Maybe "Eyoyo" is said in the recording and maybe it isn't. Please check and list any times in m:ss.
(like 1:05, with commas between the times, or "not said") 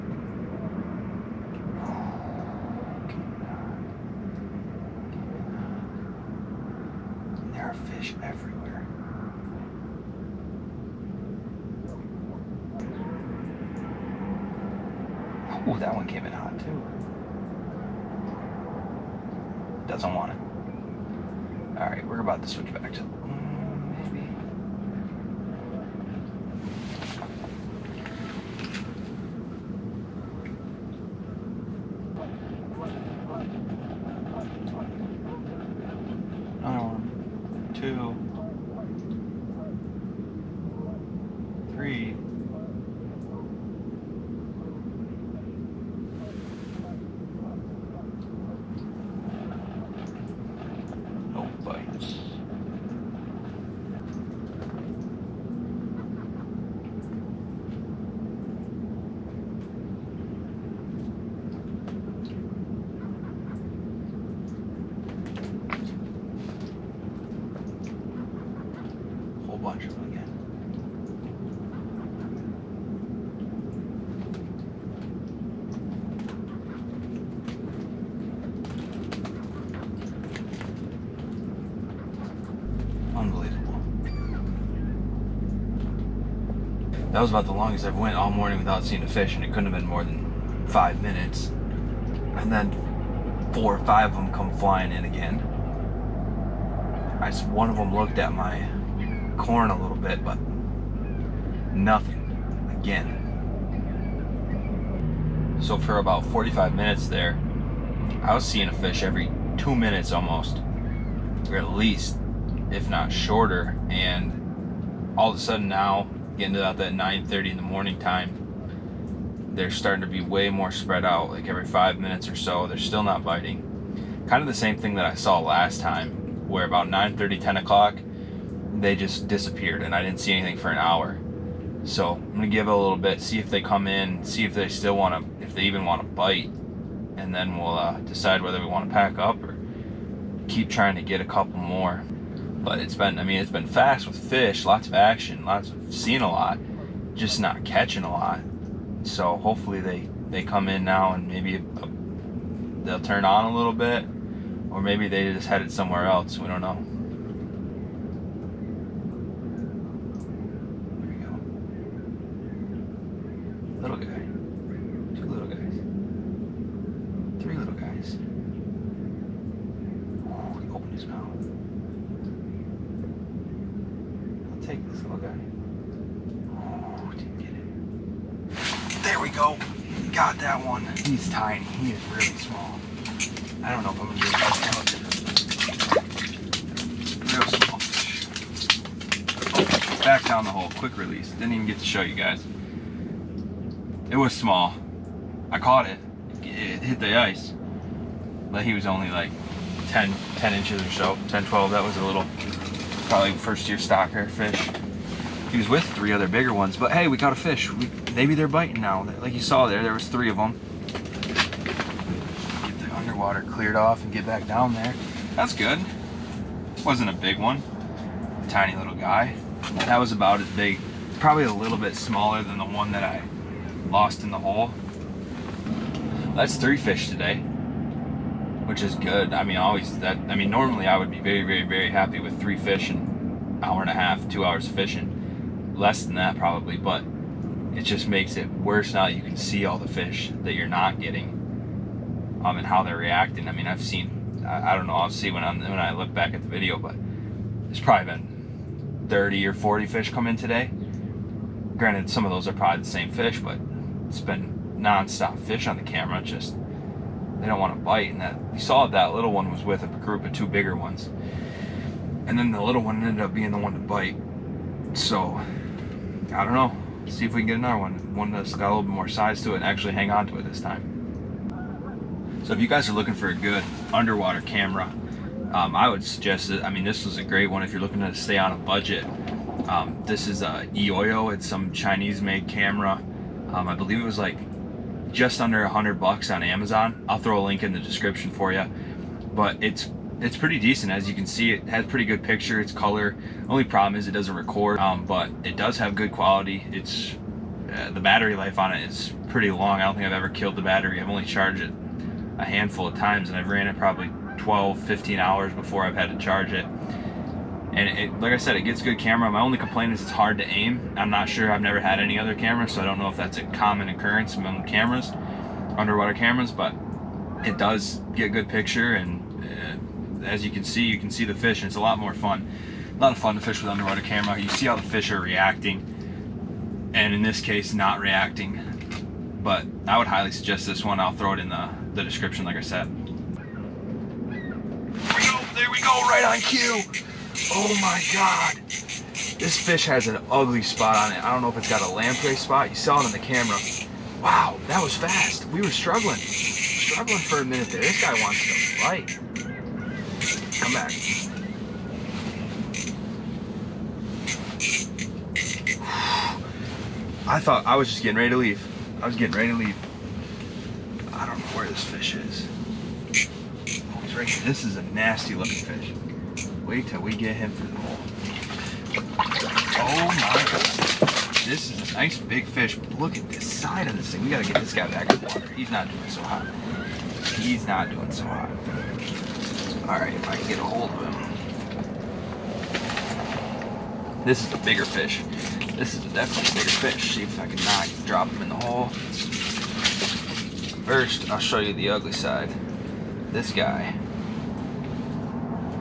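4:40.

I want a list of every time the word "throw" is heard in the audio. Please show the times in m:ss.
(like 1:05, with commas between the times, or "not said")
4:47, 5:31.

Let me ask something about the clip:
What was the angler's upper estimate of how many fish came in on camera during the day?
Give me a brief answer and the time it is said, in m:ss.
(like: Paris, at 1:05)
40, at 4:09.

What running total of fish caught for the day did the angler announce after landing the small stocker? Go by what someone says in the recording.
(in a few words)
3.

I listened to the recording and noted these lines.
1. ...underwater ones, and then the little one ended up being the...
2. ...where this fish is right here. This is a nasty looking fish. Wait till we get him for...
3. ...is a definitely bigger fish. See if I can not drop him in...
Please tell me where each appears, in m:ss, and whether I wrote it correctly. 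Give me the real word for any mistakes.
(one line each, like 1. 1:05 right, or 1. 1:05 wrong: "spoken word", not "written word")
1. 4:20 wrong: "bigger", not "underwater"
2. 6:01 right
3. 6:25 right.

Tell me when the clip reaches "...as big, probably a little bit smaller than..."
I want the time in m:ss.
3:40.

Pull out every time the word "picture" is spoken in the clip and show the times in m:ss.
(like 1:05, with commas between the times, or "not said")
4:52, 5:18.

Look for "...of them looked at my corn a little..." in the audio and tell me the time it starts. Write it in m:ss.
1:37.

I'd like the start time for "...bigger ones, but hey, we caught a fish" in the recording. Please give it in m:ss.
3:26.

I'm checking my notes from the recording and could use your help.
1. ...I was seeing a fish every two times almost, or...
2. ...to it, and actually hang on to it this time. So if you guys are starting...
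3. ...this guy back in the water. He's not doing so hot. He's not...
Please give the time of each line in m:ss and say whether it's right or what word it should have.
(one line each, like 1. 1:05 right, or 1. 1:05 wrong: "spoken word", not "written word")
1. 1:48 wrong: "minutes", not "times"
2. 4:29 wrong: "looking", not "starting"
3. 6:14 right.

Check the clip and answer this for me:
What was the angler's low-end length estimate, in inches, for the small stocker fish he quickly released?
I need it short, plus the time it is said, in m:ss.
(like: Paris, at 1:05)
10 inches, at 3:20.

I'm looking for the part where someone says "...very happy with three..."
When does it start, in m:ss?
3:51.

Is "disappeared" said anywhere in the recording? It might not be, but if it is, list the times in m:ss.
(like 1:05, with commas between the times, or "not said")
2:09.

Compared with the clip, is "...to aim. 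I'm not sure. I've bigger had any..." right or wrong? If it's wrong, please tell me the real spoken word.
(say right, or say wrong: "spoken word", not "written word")
wrong: "never", not "bigger".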